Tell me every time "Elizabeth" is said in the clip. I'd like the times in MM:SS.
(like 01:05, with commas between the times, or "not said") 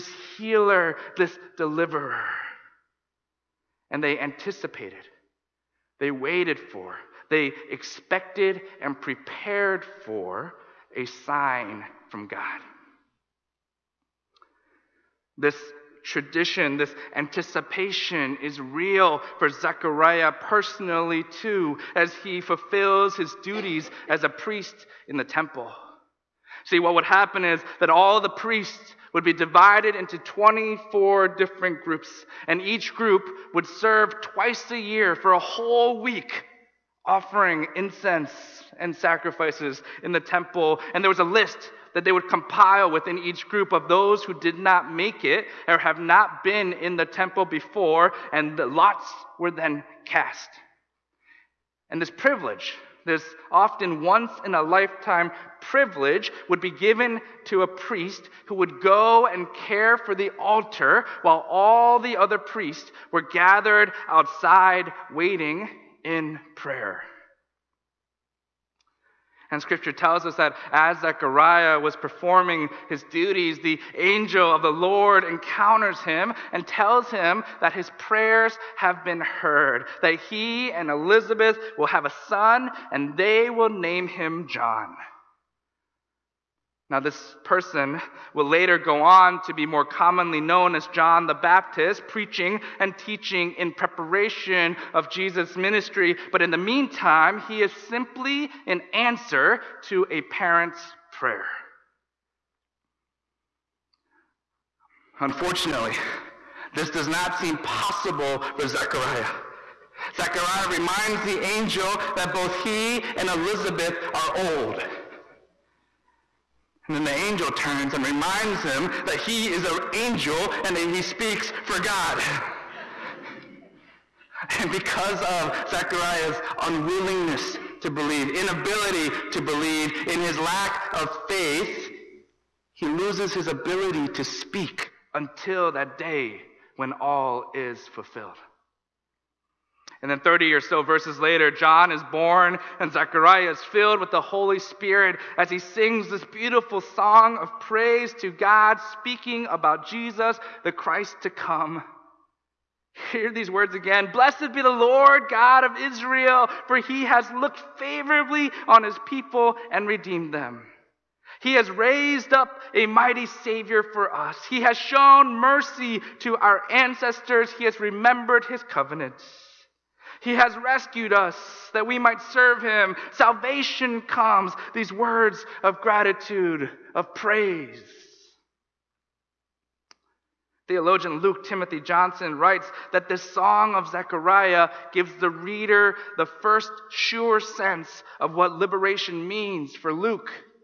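01:20, 01:53.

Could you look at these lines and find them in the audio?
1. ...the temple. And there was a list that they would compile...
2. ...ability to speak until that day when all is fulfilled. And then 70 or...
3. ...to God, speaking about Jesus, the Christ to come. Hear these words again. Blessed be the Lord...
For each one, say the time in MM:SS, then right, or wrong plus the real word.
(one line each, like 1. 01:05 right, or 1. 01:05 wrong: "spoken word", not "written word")
1. 00:40 right
2. 02:13 wrong: "30", not "70"
3. 02:28 right.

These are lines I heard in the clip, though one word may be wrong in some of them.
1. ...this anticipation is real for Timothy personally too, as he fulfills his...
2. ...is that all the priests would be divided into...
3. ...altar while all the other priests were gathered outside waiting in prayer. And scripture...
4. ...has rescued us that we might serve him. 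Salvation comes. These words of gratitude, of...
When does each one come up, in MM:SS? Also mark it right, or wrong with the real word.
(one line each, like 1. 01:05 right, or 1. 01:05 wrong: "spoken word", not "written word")
1. 00:16 wrong: "Zechariah", not "Timothy"
2. 00:27 right
3. 01:00 right
4. 02:50 right.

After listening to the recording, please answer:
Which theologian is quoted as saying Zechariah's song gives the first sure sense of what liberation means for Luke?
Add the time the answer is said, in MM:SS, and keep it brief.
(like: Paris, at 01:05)
Luke Timothy Johnson, at 03:01.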